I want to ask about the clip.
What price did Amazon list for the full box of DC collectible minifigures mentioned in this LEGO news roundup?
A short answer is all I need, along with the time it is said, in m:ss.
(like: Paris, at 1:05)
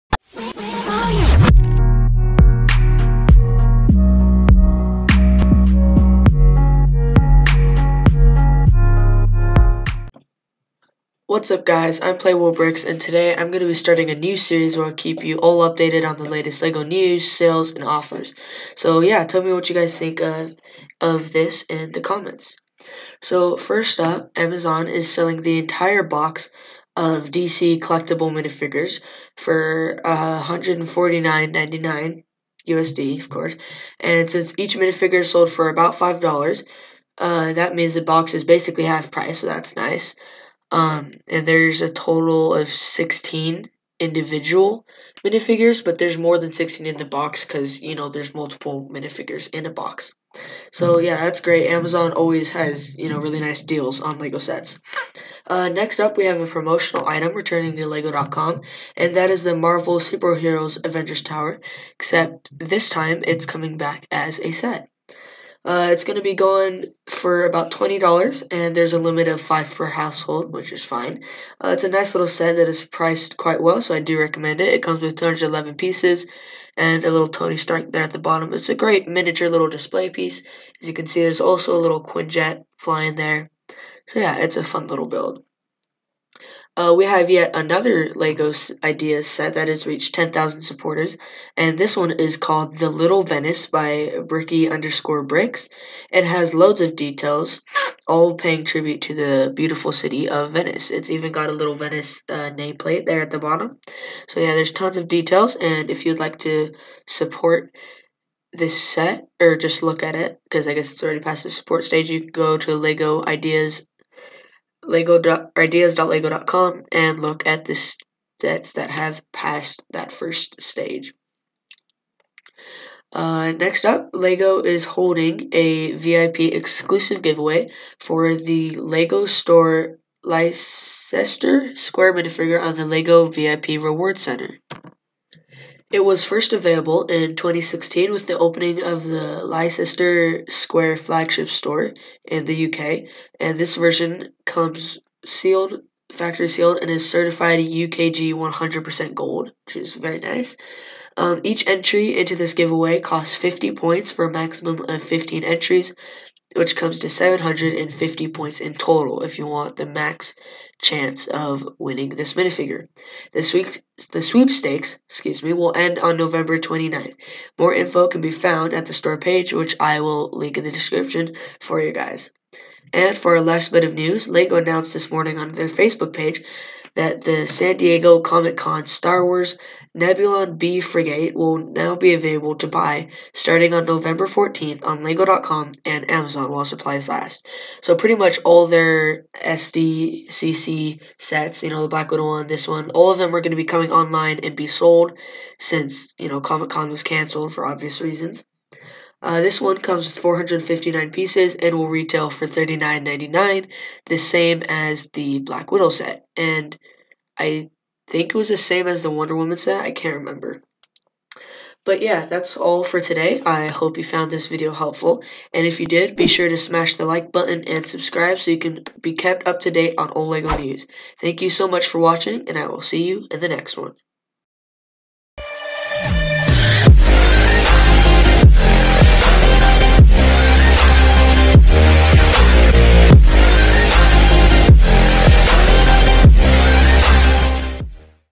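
$149.99, at 0:30.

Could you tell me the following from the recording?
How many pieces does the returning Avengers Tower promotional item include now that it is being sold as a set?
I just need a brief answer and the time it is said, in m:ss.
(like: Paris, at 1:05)
211, at 1:15.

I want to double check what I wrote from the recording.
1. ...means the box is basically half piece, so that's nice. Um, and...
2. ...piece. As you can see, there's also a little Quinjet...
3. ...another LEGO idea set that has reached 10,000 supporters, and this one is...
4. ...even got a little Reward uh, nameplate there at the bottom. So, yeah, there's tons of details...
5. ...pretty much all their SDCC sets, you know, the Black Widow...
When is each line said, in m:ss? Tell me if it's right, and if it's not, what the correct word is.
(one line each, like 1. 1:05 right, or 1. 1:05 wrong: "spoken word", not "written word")
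1. 0:37 wrong: "price", not "piece"
2. 1:20 right
3. 1:27 right
4. 1:41 wrong: "Venice", not "Reward"
5. 3:07 right.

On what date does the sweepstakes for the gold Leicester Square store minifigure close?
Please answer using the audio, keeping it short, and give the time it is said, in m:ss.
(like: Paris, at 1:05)
November 29th, at 2:46.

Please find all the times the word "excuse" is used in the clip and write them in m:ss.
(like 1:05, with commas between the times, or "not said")
2:45.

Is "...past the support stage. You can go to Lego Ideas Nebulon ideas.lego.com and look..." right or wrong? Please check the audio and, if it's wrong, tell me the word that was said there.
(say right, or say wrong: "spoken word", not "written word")
wrong: "Lego", not "Nebulon".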